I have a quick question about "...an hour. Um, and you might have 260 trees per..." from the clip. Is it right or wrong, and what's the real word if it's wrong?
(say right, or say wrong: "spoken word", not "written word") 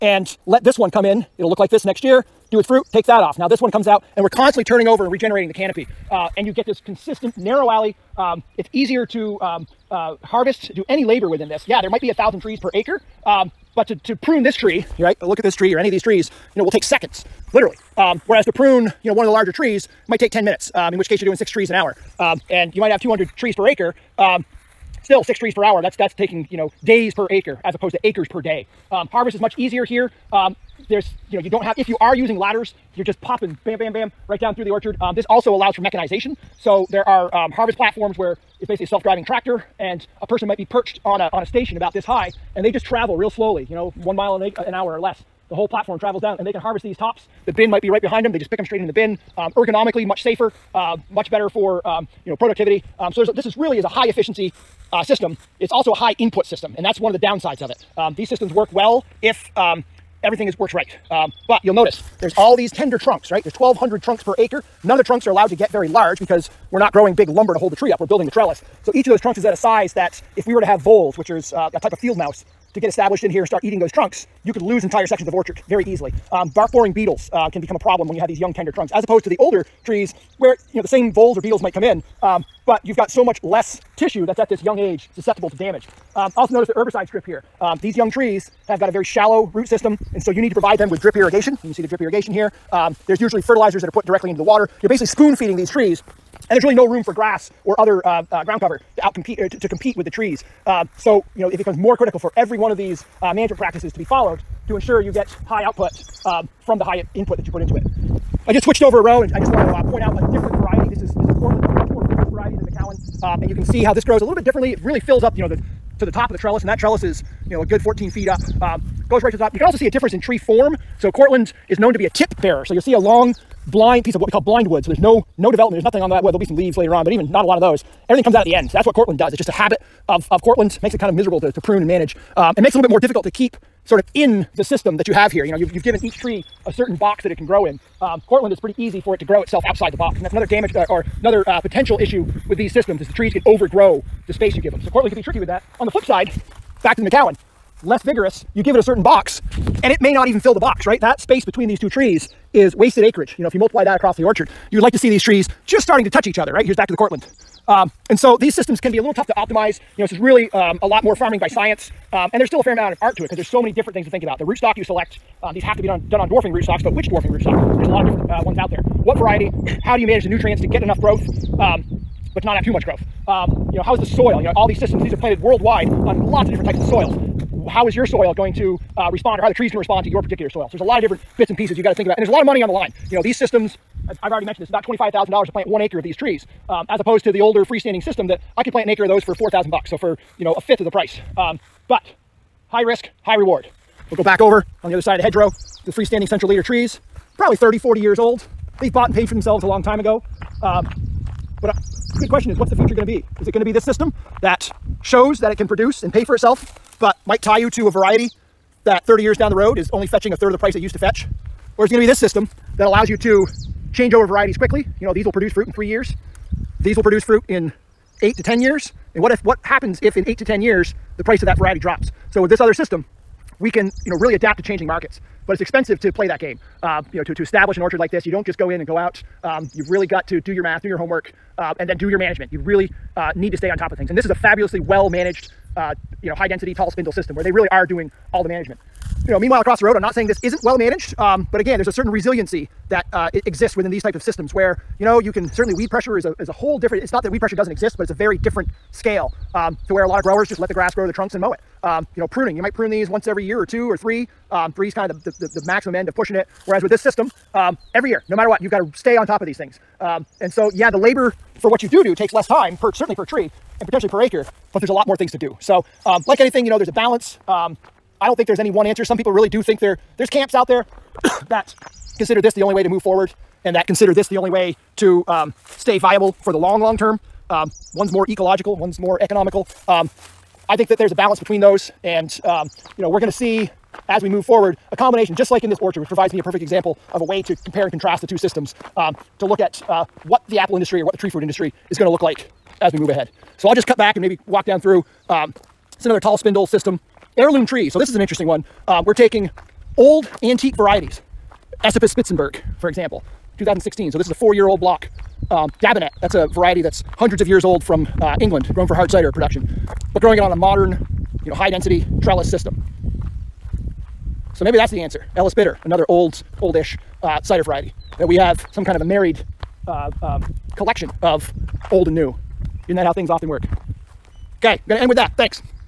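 wrong: "200", not "260".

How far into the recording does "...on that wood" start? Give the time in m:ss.
2:06.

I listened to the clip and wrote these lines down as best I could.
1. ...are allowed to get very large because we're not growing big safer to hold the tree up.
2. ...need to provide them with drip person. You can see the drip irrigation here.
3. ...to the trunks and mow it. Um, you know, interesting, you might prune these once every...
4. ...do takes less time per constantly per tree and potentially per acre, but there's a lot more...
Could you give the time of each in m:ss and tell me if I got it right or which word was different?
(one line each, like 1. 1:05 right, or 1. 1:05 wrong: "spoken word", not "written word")
1. 1:05 wrong: "lumber", not "safer"
2. 1:30 wrong: "irrigation", not "person"
3. 4:11 wrong: "pruning", not "interesting"
4. 4:22 wrong: "certainly", not "constantly".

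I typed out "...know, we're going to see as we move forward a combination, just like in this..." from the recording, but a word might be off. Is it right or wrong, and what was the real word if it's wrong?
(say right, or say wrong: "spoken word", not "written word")
right.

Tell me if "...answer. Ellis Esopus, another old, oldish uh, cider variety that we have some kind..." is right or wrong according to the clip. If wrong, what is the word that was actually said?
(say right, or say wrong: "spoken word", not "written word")
wrong: "Bitter", not "Esopus".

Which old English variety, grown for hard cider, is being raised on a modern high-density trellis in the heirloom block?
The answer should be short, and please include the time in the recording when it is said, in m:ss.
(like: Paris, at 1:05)
Dabinet, at 5:05.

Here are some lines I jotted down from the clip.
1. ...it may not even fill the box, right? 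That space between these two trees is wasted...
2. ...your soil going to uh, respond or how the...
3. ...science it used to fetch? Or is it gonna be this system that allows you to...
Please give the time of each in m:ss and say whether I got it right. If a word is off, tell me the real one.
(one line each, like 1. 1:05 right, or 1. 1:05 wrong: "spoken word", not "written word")
1. 2:29 right
2. 2:57 right
3. 3:30 wrong: "price", not "science".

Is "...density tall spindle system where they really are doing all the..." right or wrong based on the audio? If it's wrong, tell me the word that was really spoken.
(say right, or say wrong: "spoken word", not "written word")
right.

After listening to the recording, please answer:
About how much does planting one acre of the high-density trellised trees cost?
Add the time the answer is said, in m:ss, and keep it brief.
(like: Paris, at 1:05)
$25,000, at 3:04.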